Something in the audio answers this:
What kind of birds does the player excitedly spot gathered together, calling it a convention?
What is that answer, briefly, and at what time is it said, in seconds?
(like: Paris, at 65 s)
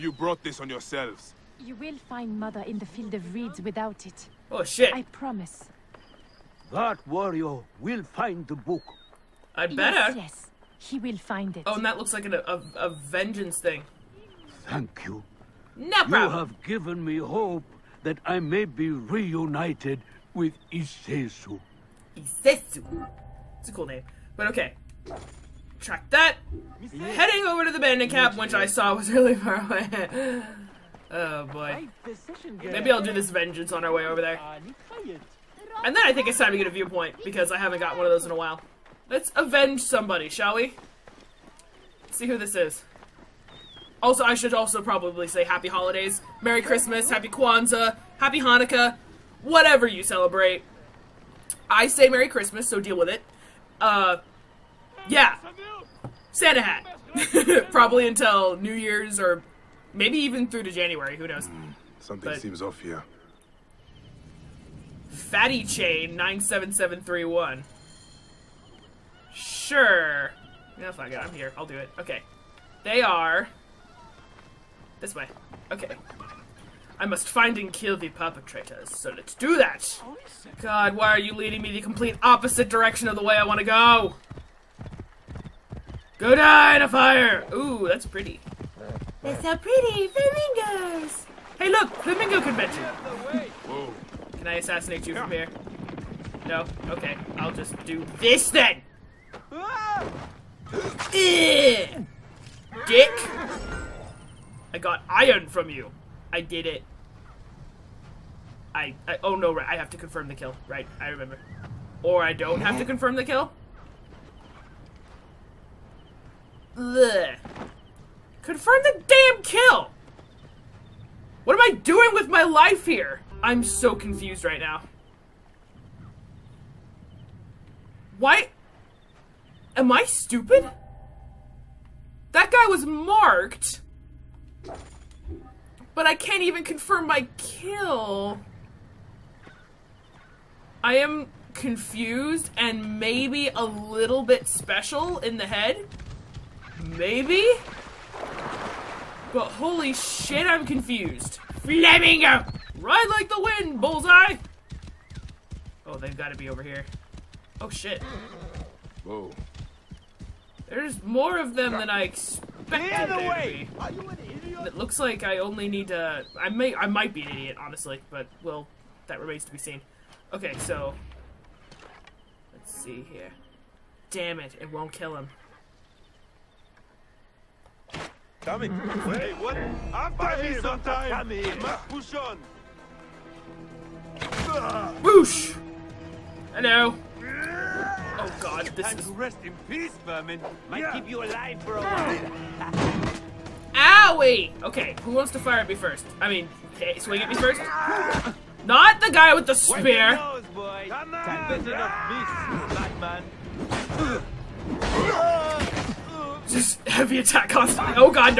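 Flamingos, at 90 s.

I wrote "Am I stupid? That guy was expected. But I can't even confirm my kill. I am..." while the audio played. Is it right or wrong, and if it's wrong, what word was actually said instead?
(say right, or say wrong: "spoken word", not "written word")
wrong: "marked", not "expected".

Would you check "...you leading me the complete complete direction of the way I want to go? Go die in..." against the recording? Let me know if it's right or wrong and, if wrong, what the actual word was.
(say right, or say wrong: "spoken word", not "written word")
wrong: "opposite", not "complete".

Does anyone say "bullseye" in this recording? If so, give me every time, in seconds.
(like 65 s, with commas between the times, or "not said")
153 s.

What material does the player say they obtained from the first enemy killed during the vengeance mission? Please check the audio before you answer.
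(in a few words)
iron.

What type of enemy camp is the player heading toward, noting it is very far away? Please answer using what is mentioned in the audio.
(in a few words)
bandit camp.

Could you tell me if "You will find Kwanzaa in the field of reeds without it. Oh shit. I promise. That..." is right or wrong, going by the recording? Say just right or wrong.
wrong.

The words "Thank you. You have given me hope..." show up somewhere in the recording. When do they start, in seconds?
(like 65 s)
14 s.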